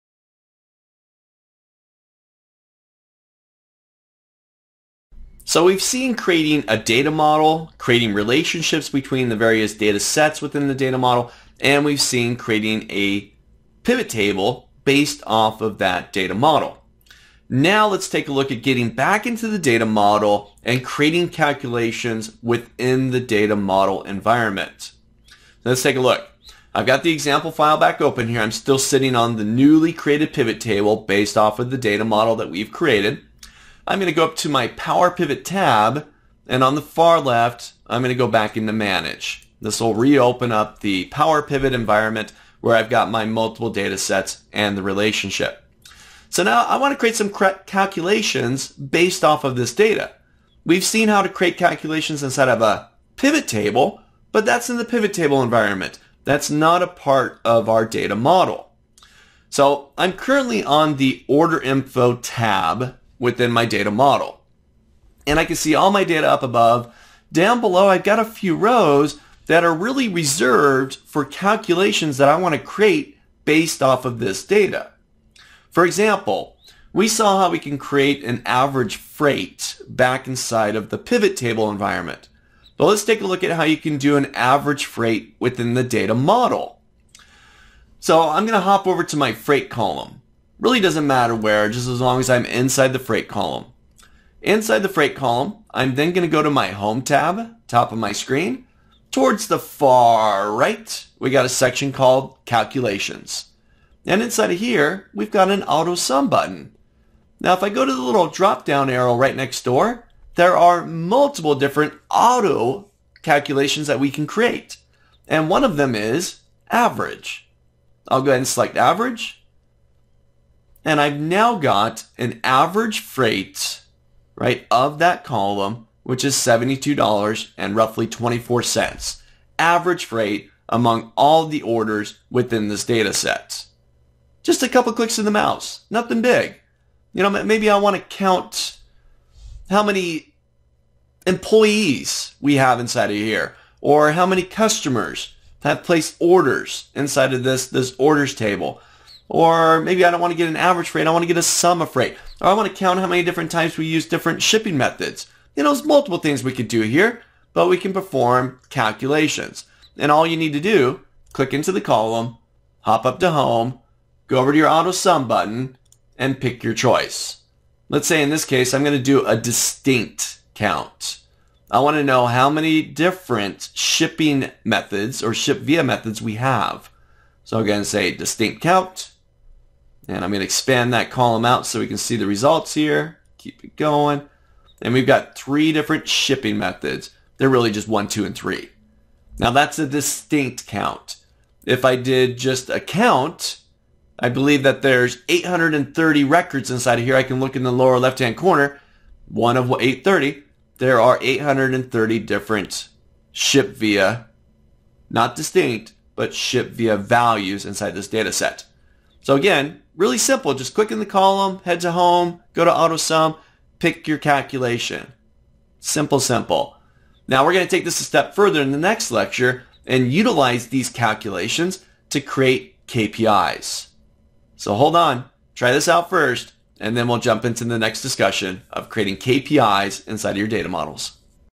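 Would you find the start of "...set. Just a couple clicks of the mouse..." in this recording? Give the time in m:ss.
2:13.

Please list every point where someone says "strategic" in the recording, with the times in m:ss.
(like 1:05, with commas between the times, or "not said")
not said.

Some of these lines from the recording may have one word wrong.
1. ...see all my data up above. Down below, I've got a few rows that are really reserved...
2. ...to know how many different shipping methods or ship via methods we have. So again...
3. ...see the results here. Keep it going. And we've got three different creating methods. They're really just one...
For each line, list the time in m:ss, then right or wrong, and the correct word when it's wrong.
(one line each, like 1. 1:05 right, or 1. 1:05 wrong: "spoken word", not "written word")
1. 1:05 right
2. 2:51 right
3. 3:01 wrong: "shipping", not "creating".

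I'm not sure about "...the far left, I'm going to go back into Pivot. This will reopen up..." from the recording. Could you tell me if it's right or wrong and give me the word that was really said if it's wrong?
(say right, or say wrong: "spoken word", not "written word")
wrong: "Manage", not "Pivot".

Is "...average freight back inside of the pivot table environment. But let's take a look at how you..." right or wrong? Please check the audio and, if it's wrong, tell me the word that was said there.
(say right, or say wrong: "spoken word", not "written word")
right.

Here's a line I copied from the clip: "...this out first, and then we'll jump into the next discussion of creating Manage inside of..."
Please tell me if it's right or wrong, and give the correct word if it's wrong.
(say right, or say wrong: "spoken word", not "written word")
wrong: "KPIs", not "Manage".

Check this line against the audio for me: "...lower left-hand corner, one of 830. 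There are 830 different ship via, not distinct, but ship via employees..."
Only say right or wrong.
wrong.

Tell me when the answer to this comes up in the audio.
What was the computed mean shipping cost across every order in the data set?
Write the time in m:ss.
2:06.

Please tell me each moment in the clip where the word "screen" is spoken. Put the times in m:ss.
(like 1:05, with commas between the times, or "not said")
1:38.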